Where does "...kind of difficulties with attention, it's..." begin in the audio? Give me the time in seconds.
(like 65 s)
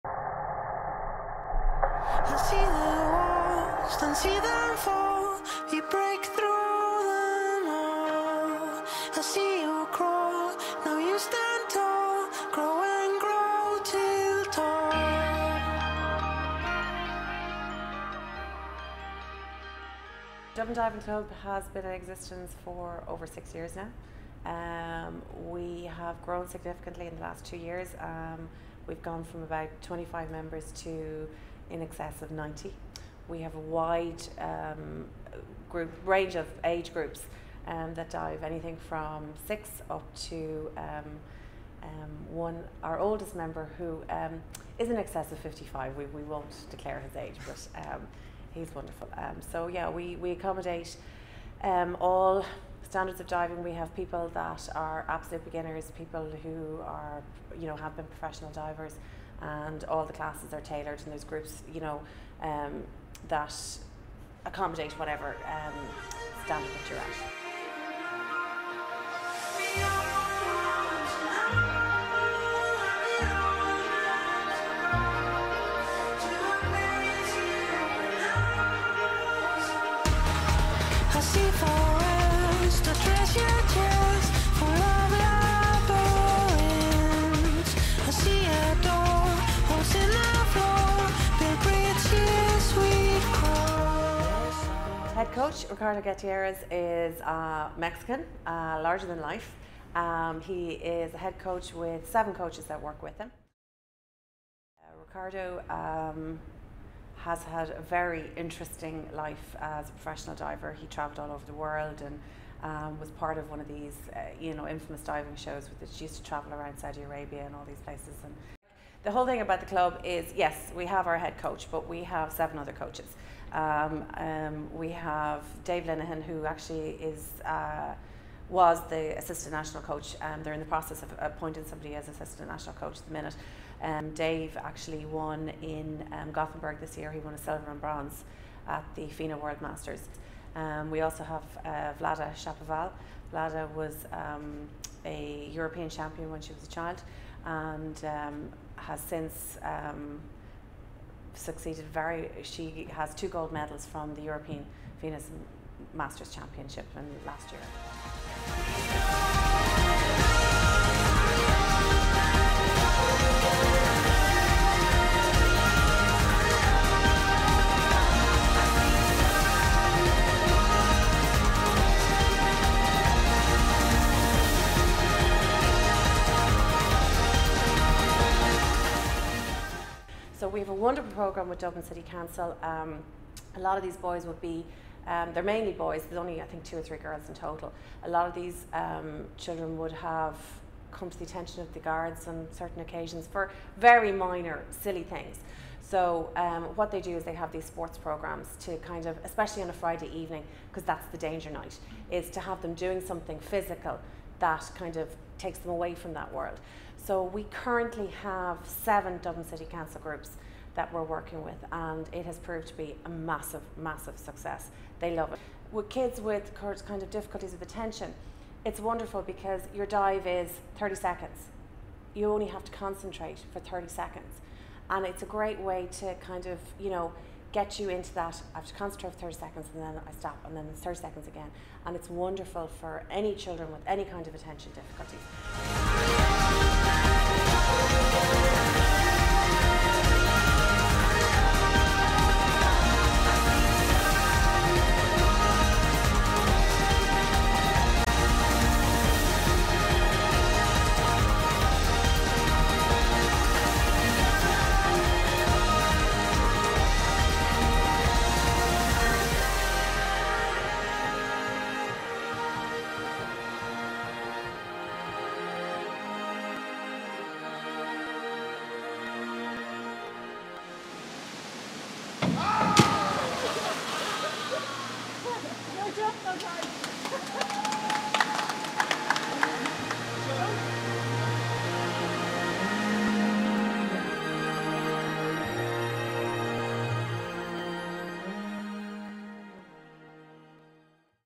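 216 s.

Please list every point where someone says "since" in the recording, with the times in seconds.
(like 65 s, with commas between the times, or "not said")
148 s.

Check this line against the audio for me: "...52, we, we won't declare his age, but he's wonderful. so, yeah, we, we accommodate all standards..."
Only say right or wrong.
wrong.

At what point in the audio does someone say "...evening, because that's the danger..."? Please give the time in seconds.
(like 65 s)
200 s.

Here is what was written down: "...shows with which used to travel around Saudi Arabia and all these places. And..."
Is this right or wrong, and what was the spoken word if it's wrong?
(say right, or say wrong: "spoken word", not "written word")
right.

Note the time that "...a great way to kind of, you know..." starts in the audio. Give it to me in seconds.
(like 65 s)
225 s.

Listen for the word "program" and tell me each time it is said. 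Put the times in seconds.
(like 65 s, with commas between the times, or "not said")
181 s, 197 s.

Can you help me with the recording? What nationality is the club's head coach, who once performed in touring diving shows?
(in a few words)
Mexican.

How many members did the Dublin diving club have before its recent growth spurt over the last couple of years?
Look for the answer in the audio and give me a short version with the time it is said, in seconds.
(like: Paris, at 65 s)
25, at 29 s.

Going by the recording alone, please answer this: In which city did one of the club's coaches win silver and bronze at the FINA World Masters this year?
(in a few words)
Gothenburg.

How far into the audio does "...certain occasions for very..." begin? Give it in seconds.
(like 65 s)
192 s.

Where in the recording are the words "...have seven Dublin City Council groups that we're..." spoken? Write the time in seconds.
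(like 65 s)
208 s.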